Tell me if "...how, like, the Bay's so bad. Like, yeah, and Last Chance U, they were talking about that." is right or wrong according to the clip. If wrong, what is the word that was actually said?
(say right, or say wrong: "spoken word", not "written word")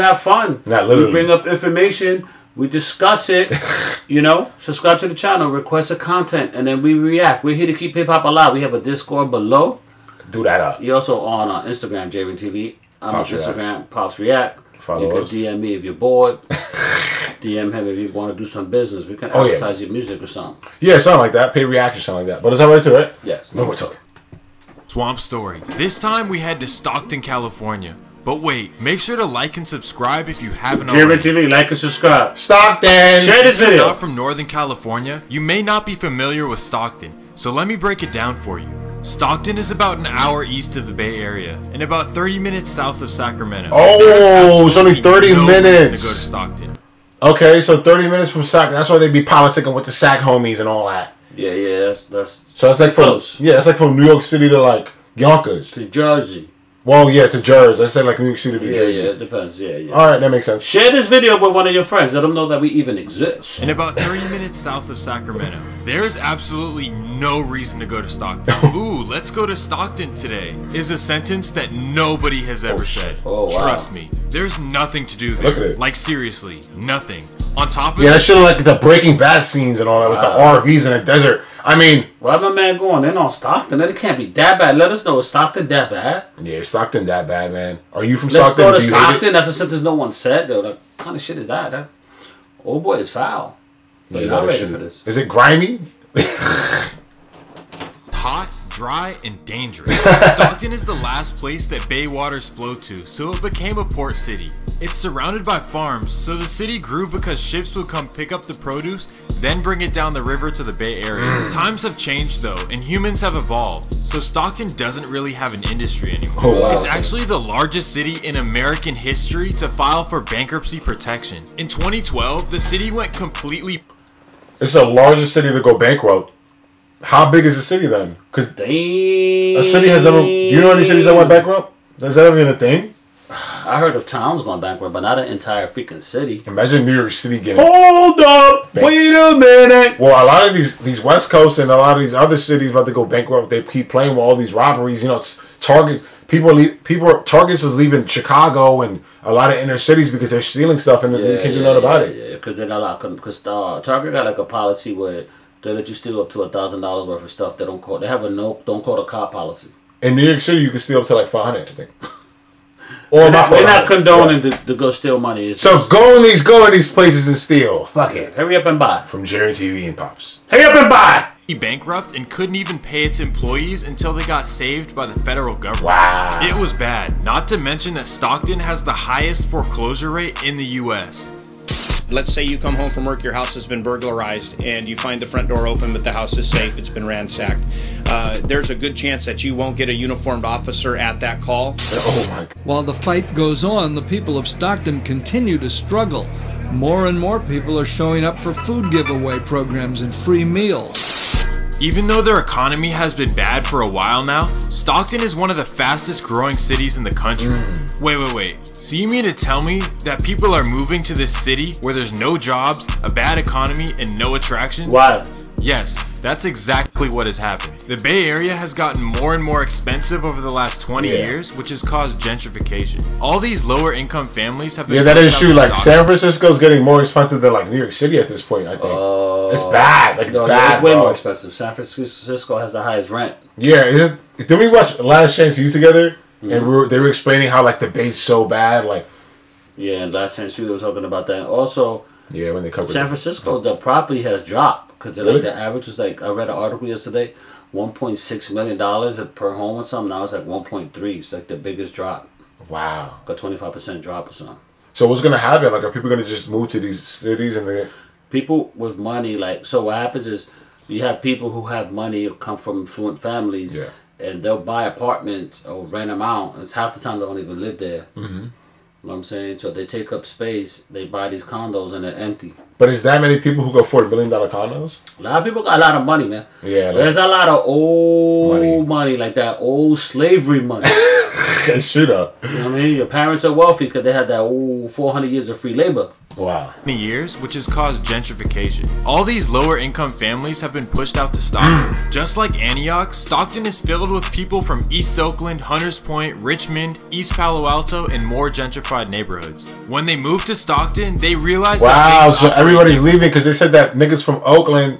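right.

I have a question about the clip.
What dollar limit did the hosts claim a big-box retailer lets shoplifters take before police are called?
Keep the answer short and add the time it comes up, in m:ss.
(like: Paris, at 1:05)
$1,000, at 2:36.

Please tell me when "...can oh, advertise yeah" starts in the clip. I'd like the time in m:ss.
0:19.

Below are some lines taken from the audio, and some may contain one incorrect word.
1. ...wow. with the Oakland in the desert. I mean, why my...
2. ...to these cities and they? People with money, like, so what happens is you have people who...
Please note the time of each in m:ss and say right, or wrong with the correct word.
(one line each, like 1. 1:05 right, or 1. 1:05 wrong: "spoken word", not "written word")
1. 1:20 wrong: "RVs", not "Oakland"
2. 4:16 right.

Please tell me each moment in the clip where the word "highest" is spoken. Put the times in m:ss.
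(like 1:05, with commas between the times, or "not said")
2:58, 3:52.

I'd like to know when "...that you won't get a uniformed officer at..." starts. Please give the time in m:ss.
3:09.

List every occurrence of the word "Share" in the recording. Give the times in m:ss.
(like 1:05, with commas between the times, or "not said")
0:33, 1:00.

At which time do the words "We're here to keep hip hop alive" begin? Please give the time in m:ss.
0:07.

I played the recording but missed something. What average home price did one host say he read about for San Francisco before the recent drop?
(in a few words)
$1.6 million.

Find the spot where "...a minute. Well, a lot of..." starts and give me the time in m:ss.
2:19.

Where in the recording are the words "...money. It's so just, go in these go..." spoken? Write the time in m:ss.
2:45.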